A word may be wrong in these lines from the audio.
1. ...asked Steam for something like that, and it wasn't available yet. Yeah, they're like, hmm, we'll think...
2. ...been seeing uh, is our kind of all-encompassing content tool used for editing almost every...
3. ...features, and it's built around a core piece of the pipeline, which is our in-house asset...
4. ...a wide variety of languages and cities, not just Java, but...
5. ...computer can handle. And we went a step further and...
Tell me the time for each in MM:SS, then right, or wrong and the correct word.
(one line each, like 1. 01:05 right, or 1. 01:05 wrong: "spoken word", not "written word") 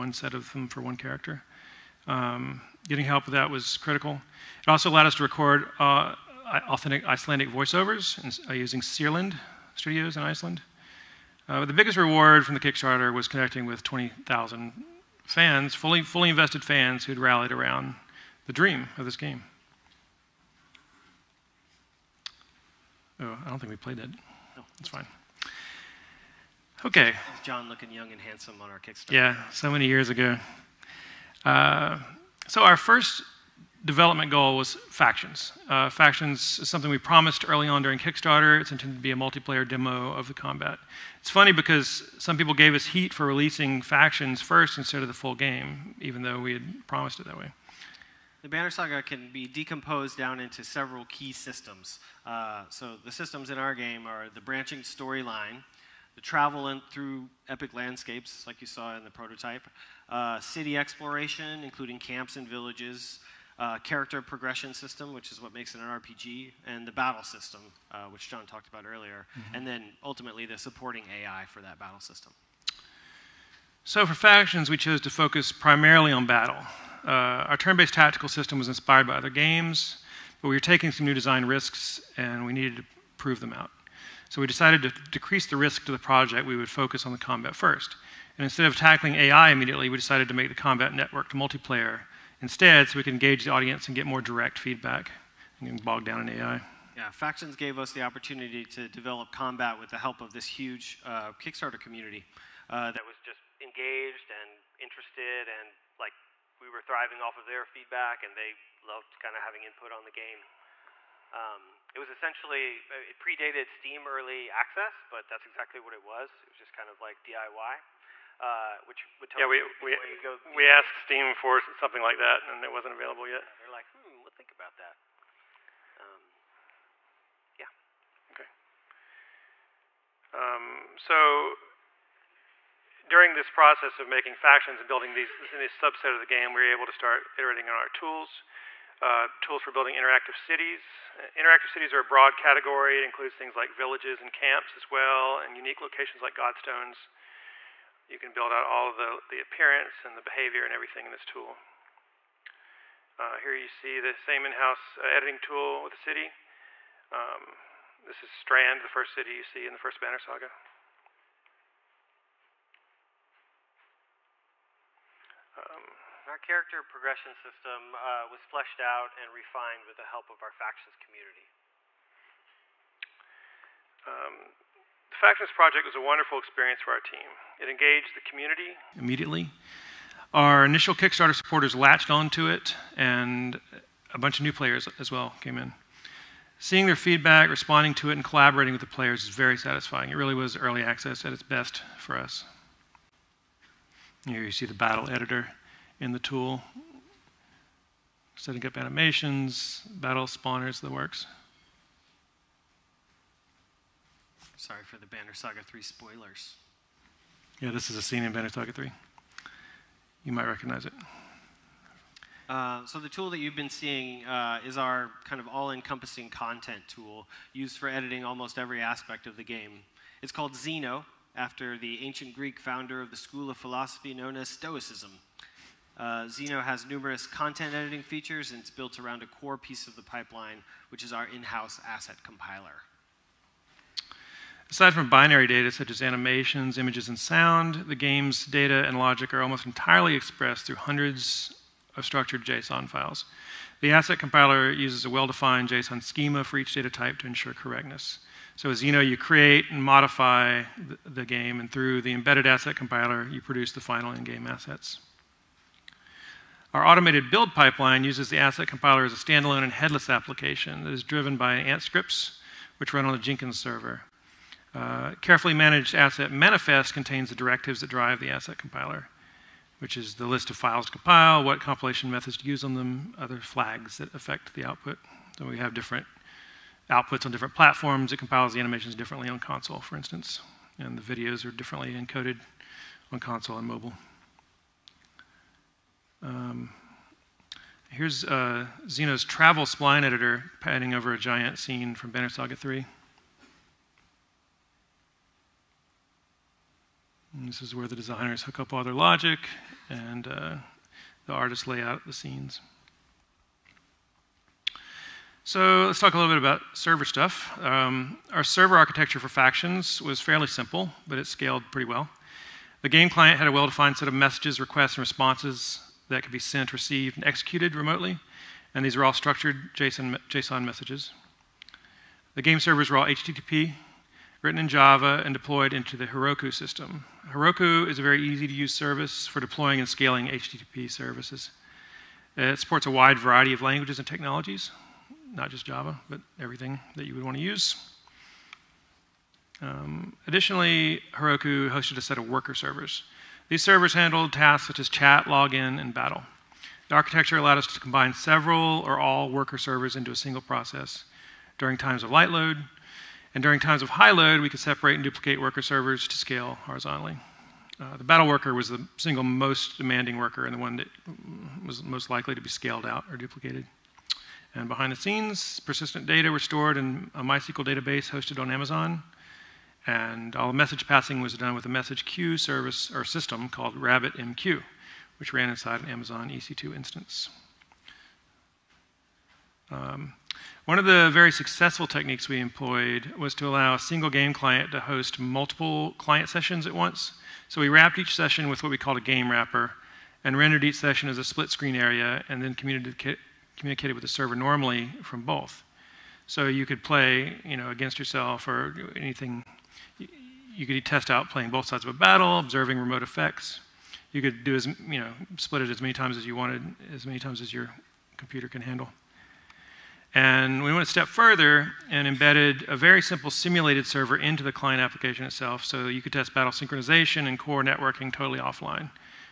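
1. 02:00 right
2. 03:33 right
3. 03:48 right
4. 05:32 wrong: "technologies", not "cities"
5. 06:48 right.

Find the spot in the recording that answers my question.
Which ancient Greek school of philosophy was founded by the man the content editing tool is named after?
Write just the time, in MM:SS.
03:44.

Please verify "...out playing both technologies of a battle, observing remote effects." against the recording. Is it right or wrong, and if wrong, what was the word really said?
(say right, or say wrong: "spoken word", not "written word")
wrong: "sides", not "technologies".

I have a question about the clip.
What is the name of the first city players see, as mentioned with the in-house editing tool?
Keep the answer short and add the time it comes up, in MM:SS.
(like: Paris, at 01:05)
Strand, at 02:38.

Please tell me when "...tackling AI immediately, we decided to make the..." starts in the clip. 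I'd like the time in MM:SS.
01:28.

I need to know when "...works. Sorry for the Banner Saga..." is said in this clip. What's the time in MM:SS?
03:20.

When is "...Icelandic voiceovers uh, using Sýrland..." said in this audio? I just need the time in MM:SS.
00:07.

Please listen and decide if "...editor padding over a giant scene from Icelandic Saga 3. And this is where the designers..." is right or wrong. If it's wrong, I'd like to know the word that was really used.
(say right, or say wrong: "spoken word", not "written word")
wrong: "Banner", not "Icelandic".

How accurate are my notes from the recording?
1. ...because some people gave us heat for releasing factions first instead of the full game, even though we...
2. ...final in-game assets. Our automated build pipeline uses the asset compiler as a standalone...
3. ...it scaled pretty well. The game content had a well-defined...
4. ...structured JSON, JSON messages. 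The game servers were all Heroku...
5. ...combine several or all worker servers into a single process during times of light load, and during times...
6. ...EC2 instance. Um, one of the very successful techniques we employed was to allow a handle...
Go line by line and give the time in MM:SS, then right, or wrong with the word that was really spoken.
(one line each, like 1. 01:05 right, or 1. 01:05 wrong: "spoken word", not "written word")
1. 00:41 right
2. 04:13 right
3. 05:11 wrong: "client", not "content"
4. 05:19 wrong: "HTTP", not "Heroku"
5. 05:47 right
6. 06:16 wrong: "single", not "handle".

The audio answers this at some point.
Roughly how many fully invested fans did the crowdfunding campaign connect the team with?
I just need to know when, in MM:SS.
00:13.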